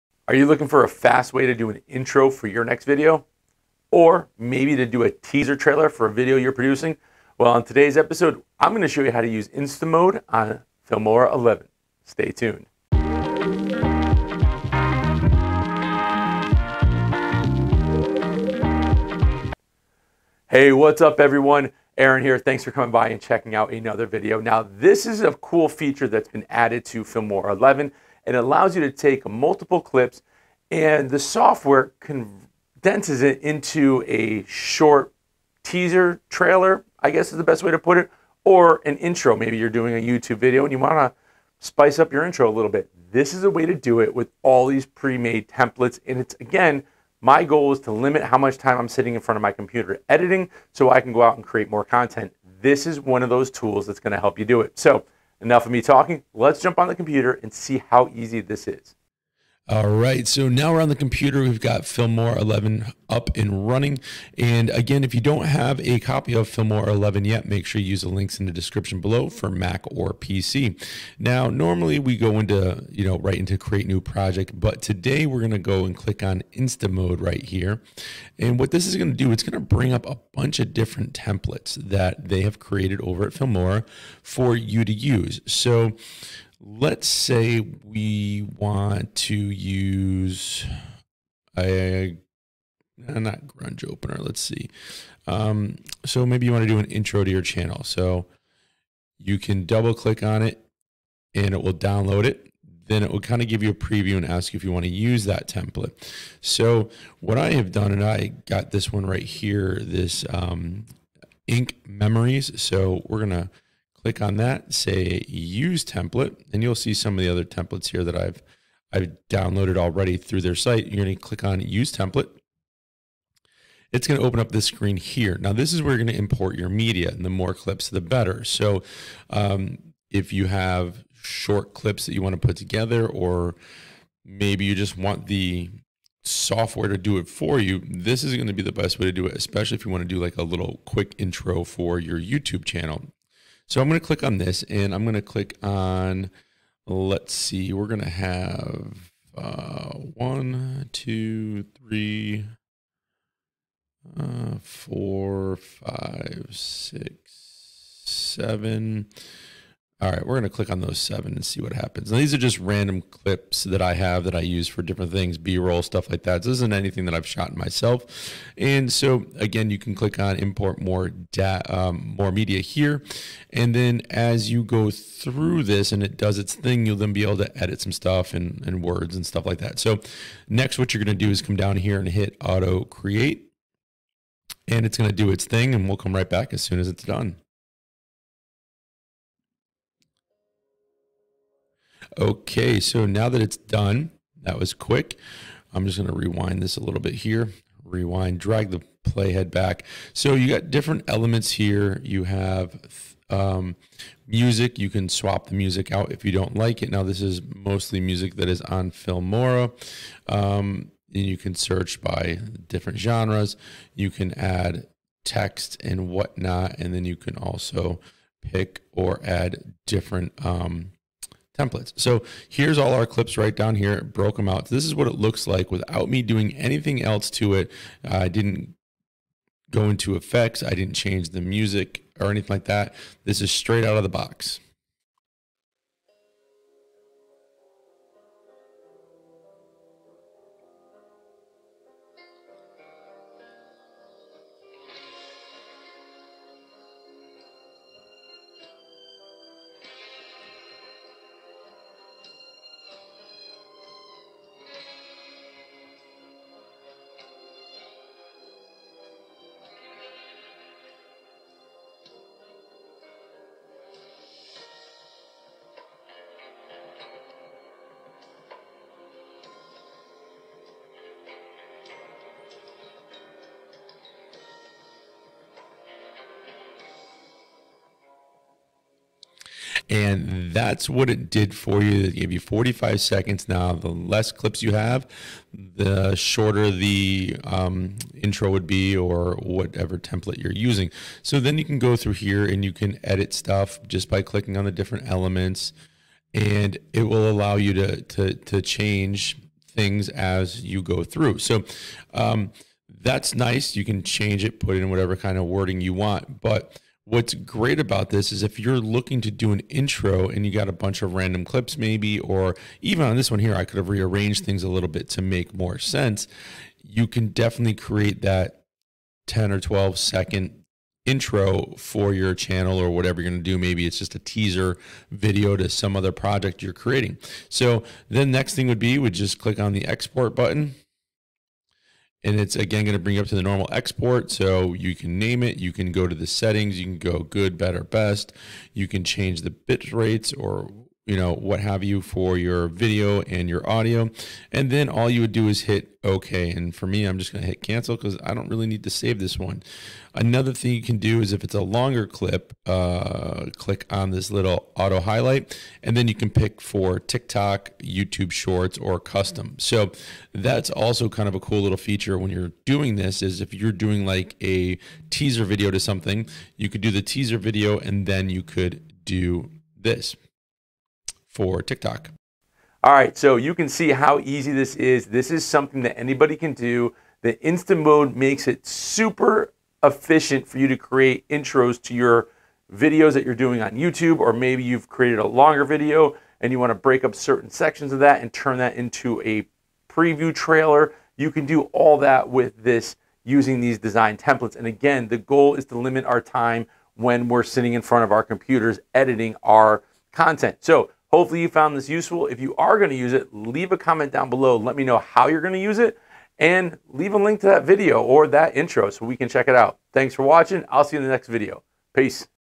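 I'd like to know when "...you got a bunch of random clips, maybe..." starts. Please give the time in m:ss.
5:10.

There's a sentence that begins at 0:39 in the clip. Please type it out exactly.
Maybe you're doing a YouTube video and you want to spice up your intro a little bit.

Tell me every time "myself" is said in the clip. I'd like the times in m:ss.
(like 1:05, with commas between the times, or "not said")
2:47.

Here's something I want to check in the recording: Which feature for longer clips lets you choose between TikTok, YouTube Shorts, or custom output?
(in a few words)
Auto highlight.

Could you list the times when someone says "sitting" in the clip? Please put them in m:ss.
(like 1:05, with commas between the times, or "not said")
0:48, 6:37.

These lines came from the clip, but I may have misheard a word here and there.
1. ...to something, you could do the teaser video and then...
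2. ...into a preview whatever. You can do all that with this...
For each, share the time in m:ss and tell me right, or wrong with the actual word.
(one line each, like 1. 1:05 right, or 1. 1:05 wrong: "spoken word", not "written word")
1. 6:05 right
2. 6:28 wrong: "trailer", not "whatever".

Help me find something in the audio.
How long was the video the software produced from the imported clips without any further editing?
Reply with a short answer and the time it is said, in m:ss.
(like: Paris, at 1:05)
45 seconds, at 4:42.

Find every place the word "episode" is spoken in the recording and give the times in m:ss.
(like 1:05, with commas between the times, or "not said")
0:07.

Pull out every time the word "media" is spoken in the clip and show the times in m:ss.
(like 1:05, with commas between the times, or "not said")
2:06, 2:52.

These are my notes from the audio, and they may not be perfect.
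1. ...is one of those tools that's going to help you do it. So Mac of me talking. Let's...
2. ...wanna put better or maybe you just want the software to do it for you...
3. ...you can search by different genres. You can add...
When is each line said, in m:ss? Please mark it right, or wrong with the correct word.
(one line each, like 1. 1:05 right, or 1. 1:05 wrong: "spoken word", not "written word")
1. 0:52 wrong: "Enough", not "Mac"
2. 2:12 wrong: "together", not "better"
3. 3:31 right.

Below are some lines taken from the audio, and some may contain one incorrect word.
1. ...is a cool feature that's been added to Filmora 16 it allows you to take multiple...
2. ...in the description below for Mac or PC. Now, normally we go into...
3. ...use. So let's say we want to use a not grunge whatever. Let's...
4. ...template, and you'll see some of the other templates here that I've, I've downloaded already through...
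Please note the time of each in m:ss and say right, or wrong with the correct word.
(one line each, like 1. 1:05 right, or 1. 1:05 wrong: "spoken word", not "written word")
1. 0:25 wrong: "11", not "16"
2. 1:08 right
3. 1:24 wrong: "opener", not "whatever"
4. 1:55 right.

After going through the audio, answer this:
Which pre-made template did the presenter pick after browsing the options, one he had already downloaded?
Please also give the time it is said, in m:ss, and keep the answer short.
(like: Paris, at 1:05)
Ink Memories, at 1:51.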